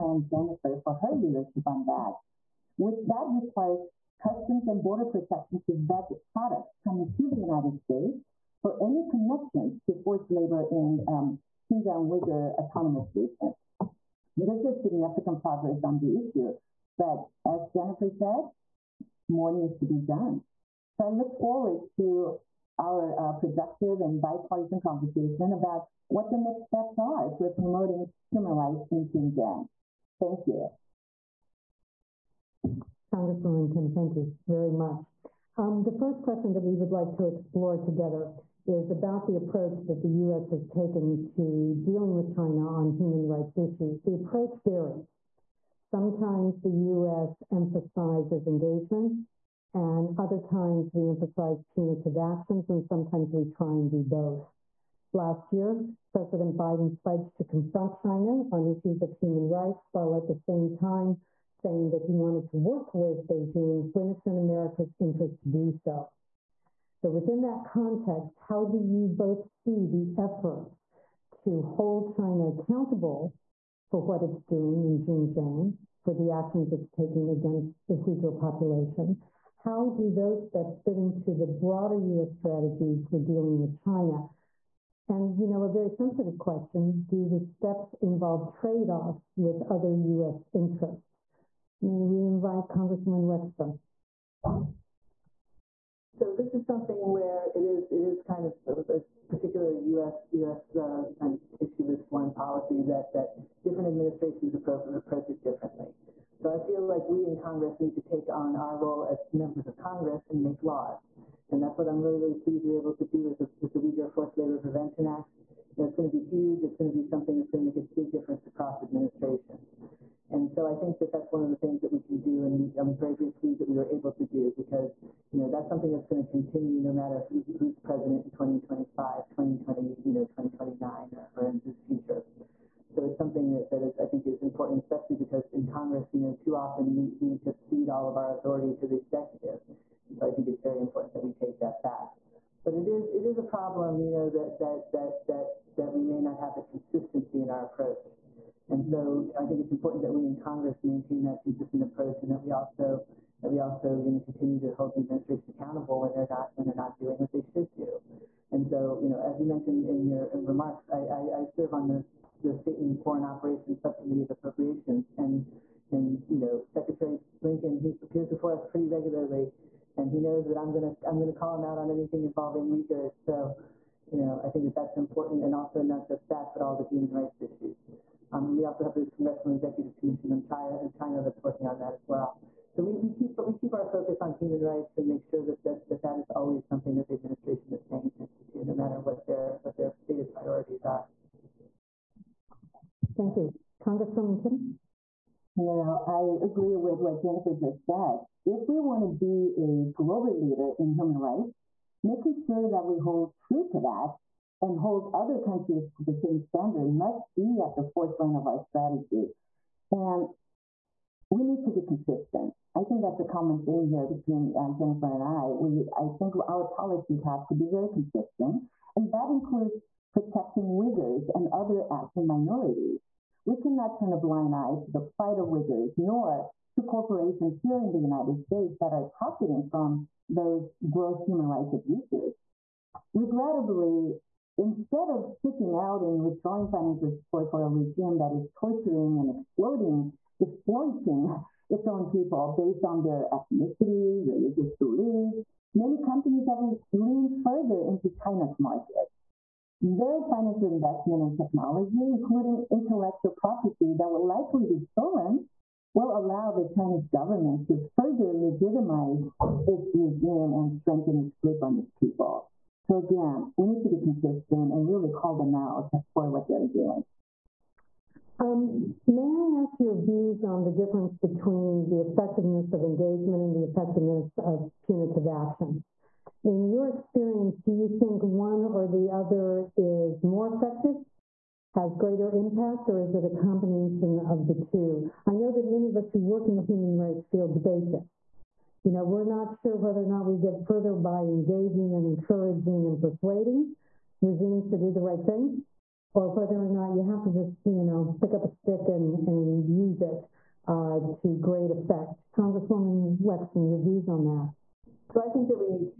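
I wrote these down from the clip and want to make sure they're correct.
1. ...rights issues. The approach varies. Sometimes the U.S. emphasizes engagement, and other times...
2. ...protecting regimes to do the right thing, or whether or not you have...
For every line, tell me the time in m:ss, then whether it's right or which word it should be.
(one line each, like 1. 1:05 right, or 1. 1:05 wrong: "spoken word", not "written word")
1. 0:43 right
2. 4:53 wrong: "persuading", not "protecting".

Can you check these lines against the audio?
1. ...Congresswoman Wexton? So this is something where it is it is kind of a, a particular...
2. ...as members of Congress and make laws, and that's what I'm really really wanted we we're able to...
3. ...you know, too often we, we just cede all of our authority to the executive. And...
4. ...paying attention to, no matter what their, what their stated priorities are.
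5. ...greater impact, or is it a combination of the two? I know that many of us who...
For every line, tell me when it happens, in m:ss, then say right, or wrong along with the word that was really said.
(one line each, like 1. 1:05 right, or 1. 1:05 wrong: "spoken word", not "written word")
1. 1:32 right
2. 1:49 wrong: "pleased", not "wanted"
3. 2:16 right
4. 3:07 right
5. 4:41 right.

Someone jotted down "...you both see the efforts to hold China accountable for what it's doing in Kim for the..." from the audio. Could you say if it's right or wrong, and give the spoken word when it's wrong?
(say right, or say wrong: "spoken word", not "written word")
wrong: "Xinjiang", not "Kim".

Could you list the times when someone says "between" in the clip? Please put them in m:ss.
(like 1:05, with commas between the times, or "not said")
3:34, 4:31.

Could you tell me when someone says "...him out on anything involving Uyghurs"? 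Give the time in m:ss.
2:51.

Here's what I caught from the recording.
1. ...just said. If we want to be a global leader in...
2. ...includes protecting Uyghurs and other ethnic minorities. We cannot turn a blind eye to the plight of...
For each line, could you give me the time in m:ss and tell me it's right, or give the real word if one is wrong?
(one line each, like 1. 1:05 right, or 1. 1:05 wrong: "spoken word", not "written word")
1. 3:17 right
2. 3:39 right.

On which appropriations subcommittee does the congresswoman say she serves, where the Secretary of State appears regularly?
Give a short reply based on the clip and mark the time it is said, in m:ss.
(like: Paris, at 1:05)
State and Foreign Operations, at 2:42.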